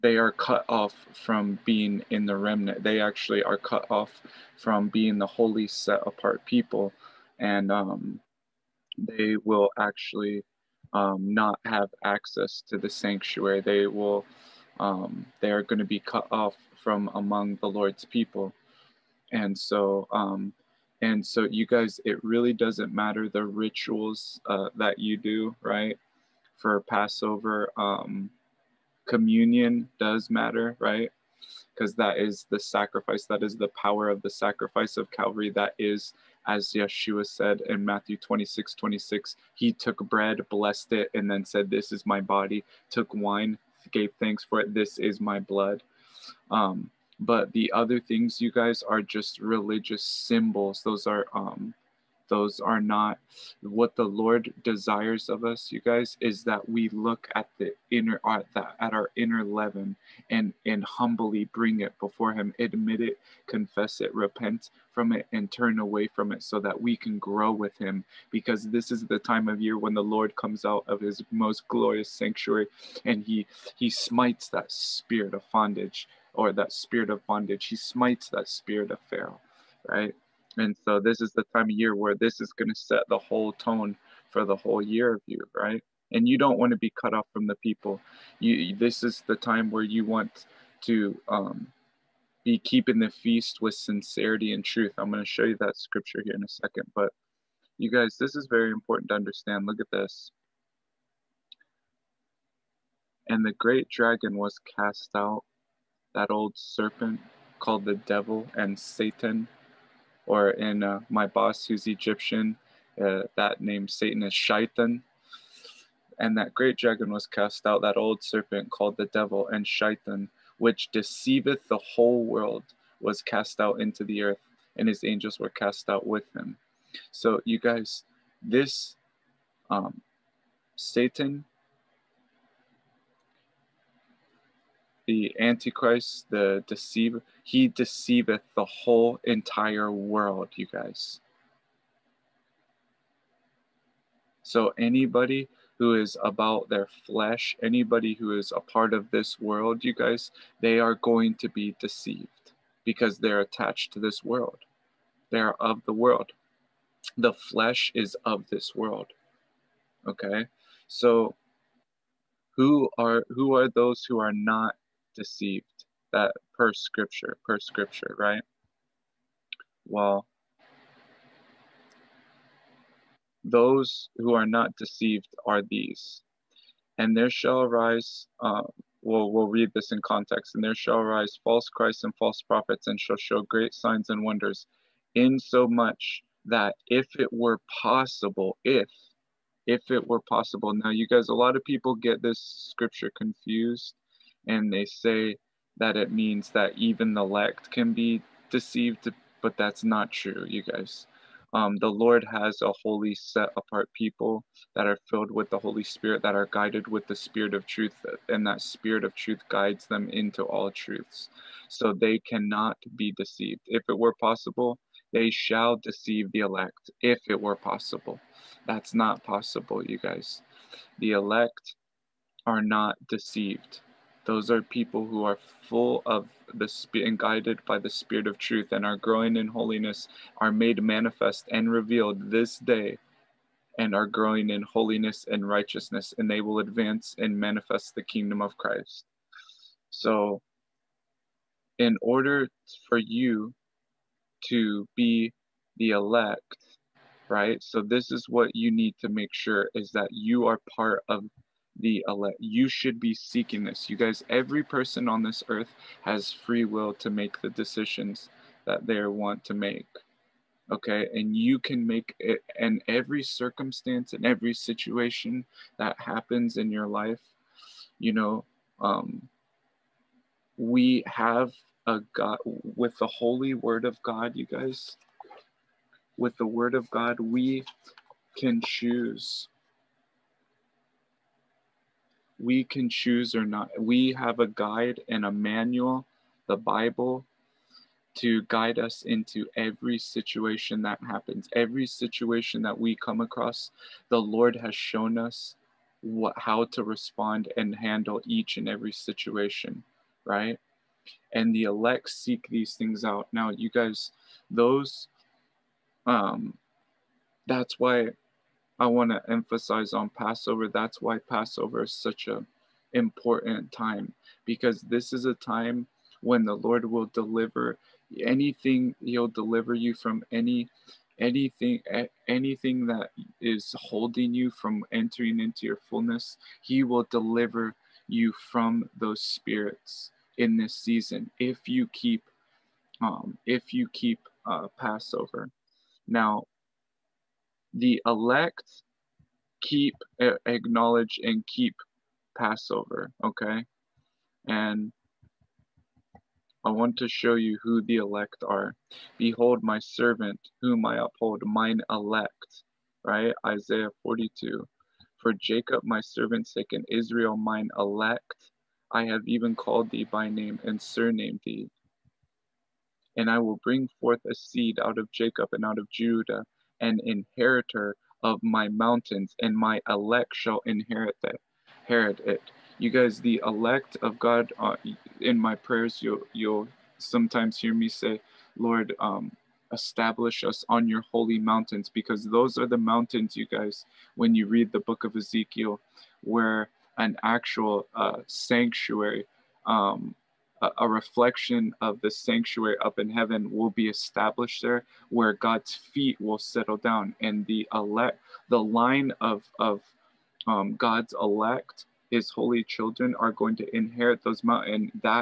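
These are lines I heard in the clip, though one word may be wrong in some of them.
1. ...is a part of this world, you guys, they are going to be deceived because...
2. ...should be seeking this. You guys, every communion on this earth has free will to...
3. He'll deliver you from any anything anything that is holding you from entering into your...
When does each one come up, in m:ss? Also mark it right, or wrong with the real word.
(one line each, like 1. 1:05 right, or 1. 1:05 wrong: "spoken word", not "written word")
1. 2:28 right
2. 4:12 wrong: "person", not "communion"
3. 5:18 right.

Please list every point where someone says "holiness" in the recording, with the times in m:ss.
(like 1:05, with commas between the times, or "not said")
3:49, 3:54.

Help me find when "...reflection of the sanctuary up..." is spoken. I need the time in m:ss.
6:30.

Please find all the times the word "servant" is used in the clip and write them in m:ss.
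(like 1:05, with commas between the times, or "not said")
5:49, 5:56.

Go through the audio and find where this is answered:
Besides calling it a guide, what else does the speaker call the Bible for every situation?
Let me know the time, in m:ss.
4:45.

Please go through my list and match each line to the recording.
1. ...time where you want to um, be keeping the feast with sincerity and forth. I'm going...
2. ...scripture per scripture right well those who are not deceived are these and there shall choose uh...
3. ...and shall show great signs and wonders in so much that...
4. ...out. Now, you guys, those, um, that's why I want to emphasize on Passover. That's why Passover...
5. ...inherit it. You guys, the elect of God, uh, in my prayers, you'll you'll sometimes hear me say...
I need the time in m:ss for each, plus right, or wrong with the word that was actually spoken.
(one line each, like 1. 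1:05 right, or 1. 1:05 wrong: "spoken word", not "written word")
1. 1:29 wrong: "truth", not "forth"
2. 2:46 wrong: "arise", not "choose"
3. 3:02 right
4. 5:03 right
5. 6:11 right.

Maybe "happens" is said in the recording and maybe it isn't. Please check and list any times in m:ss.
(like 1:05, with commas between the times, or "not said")
4:25, 4:51.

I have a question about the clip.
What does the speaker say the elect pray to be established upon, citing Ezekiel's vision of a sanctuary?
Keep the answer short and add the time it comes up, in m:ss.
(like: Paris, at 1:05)
Holy mountains, at 6:21.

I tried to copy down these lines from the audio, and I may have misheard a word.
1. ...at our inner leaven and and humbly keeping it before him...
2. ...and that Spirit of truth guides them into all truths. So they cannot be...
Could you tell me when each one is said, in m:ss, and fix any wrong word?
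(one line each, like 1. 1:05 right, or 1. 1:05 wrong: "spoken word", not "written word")
1. 0:58 wrong: "bring", not "keeping"
2. 3:28 right.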